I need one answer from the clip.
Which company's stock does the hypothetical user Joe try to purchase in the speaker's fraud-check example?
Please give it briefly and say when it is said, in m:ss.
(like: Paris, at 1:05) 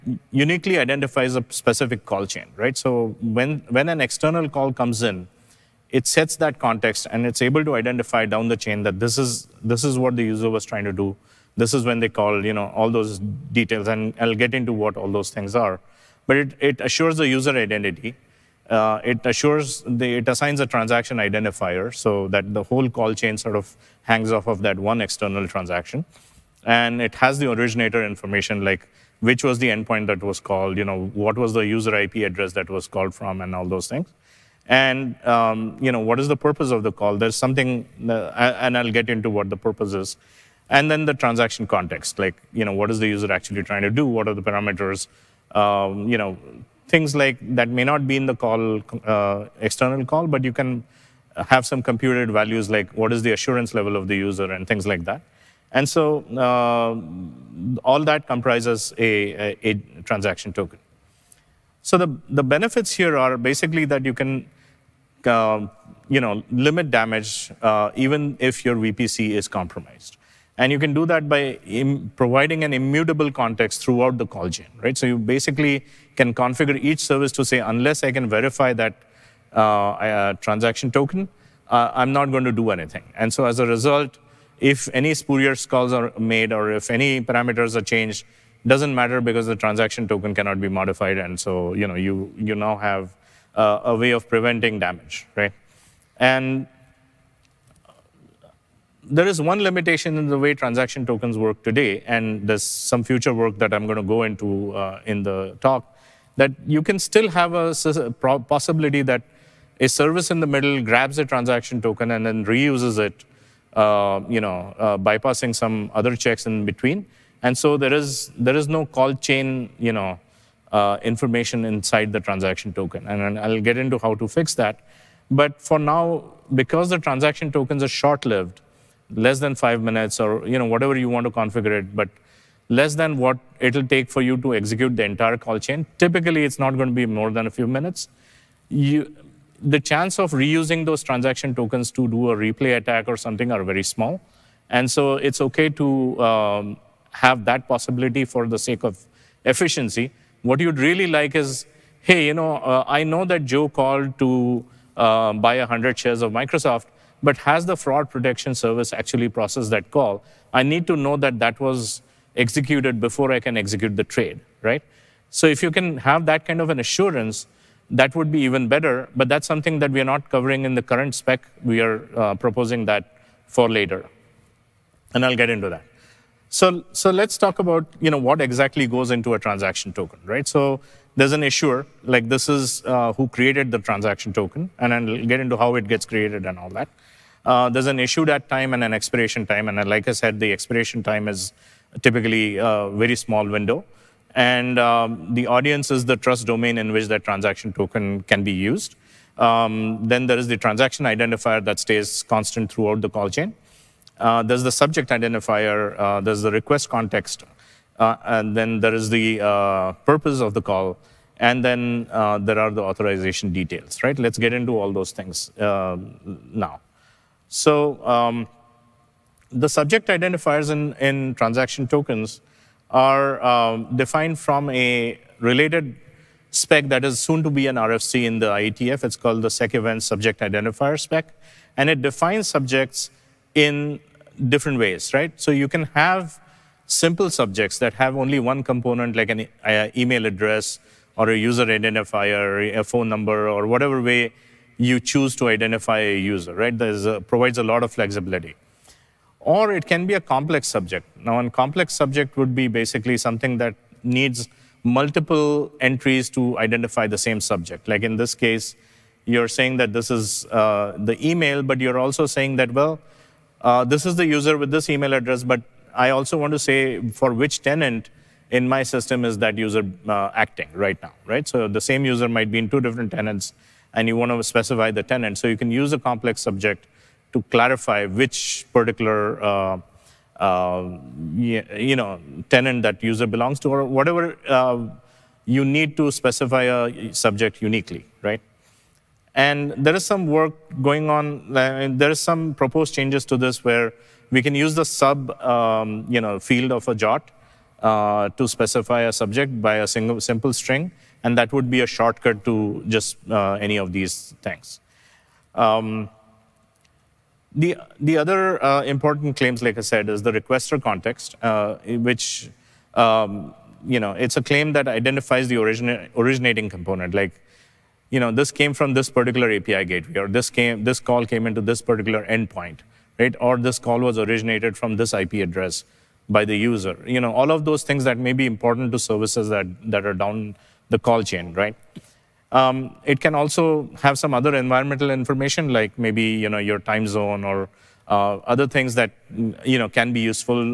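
Microsoft, at 2:36.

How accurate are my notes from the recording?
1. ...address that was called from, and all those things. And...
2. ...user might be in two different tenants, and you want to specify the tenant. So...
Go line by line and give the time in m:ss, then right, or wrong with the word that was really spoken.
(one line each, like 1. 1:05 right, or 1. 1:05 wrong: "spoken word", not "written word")
1. 0:32 right
2. 4:32 right.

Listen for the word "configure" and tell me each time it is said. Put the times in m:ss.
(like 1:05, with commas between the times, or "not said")
1:16, 2:11.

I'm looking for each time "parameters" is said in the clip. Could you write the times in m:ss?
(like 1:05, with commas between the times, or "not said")
0:44, 1:27.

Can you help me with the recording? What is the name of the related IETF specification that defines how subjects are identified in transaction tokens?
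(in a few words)
SEC event subject identifier.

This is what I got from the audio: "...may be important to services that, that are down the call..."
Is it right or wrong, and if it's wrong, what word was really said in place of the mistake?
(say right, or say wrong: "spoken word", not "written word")
right.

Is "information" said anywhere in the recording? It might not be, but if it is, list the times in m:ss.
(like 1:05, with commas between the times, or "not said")
0:28, 2:01, 5:35.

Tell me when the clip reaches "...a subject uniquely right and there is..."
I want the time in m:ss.
4:46.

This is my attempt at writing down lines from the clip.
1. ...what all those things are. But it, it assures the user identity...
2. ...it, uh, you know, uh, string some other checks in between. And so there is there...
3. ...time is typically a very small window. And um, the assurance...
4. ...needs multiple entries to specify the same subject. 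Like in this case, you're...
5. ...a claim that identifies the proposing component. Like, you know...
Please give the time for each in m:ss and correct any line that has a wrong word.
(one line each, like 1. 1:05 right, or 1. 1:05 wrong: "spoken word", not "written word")
1. 0:14 right
2. 1:52 wrong: "bypassing", not "string"
3. 3:11 wrong: "audience", not "assurance"
4. 4:14 wrong: "identify", not "specify"
5. 5:14 wrong: "originating", not "proposing".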